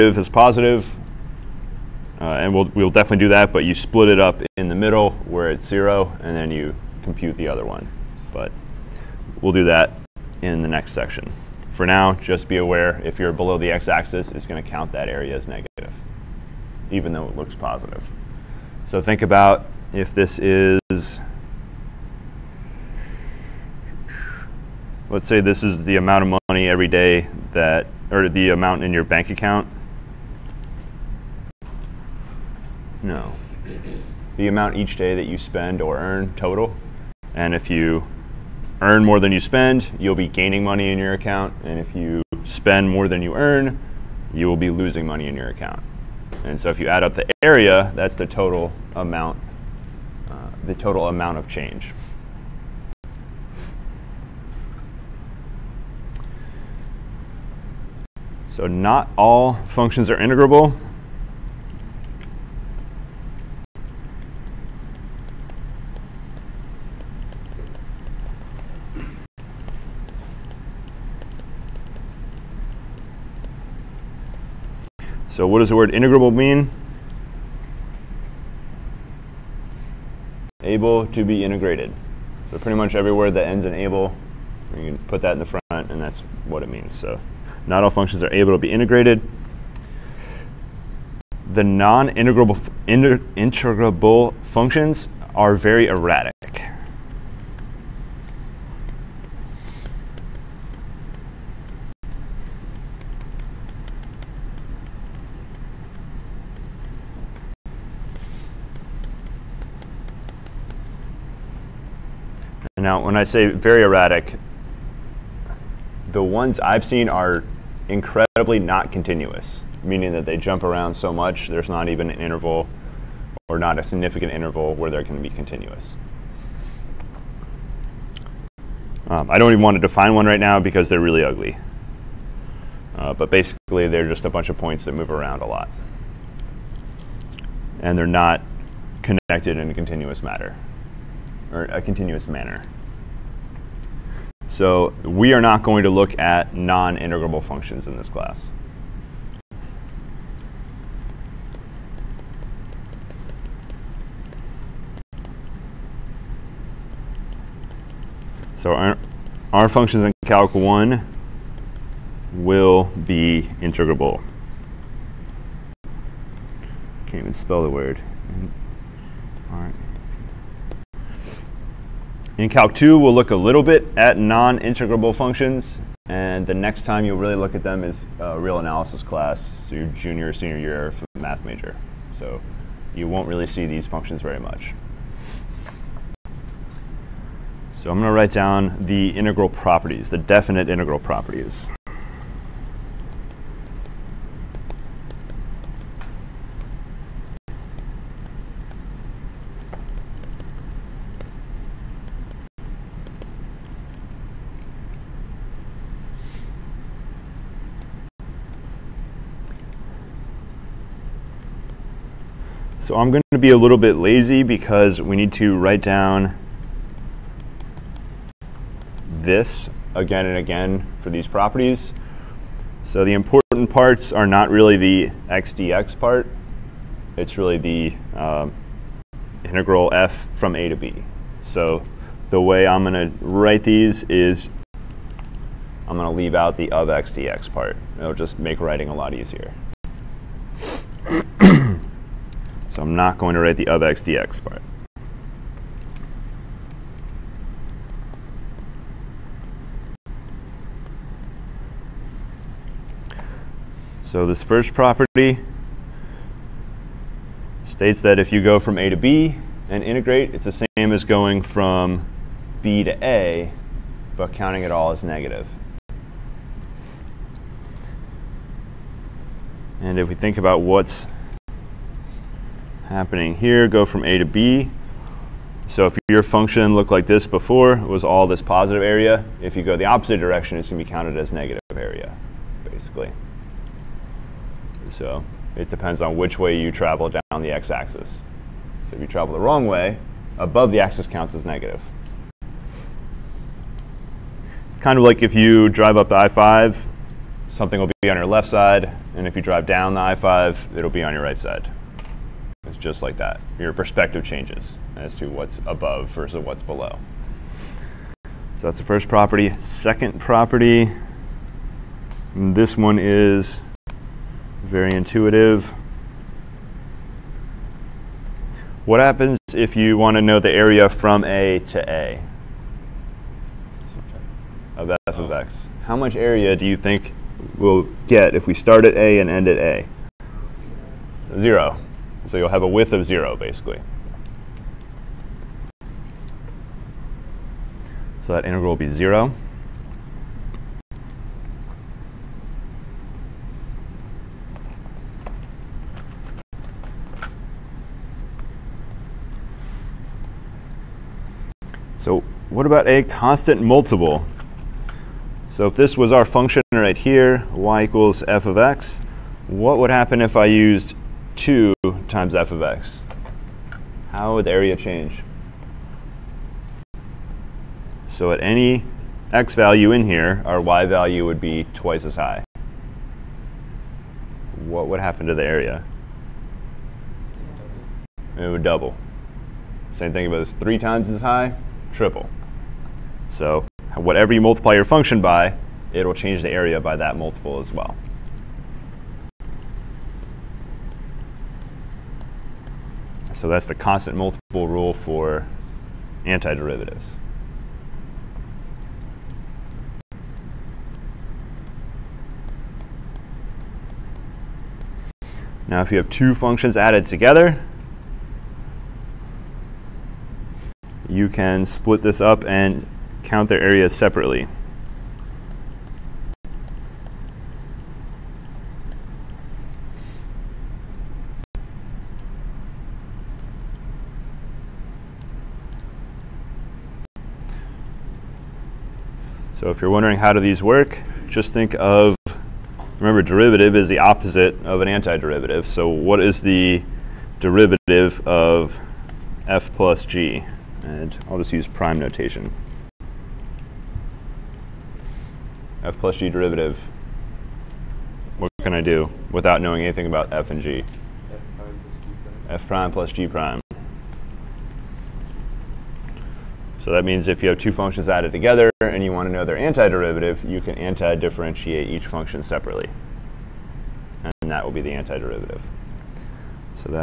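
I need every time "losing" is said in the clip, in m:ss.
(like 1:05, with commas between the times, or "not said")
0:44.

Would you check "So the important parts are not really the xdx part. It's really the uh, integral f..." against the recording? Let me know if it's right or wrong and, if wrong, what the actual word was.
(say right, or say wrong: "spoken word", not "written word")
right.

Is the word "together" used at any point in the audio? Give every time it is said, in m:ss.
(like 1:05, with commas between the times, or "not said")
6:47, 7:38.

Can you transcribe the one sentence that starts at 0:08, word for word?
But we'll do that in the next section.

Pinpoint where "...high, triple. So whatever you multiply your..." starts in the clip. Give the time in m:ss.
6:21.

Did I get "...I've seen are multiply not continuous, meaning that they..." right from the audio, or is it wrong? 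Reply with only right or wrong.
wrong.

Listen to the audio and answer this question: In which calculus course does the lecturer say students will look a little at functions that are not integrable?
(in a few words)
Calc 2.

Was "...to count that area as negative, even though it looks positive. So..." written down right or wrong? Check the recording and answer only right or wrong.
right.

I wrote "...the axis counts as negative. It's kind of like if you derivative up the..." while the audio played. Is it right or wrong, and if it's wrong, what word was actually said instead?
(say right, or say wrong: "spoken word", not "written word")
wrong: "drive", not "derivative".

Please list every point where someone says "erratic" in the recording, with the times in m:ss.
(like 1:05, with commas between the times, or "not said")
1:35, 1:53.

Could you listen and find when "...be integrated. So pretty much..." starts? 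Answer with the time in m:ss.
1:21.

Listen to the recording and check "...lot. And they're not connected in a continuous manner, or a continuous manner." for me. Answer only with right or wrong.
wrong.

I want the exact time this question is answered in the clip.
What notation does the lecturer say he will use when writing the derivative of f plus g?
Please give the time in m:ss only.
7:21.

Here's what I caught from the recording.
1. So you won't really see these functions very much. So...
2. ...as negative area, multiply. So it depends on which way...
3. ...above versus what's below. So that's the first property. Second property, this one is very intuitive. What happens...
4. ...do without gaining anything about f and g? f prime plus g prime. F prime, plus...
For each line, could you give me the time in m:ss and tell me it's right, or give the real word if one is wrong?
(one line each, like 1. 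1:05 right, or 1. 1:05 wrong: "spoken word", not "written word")
1. 3:02 right
2. 4:41 wrong: "basically", not "multiply"
3. 5:05 right
4. 7:28 wrong: "knowing", not "gaining".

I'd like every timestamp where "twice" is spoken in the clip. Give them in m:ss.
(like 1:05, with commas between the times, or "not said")
6:11.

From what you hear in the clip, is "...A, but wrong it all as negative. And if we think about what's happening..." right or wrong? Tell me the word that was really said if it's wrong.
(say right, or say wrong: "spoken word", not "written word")
wrong: "counting", not "wrong".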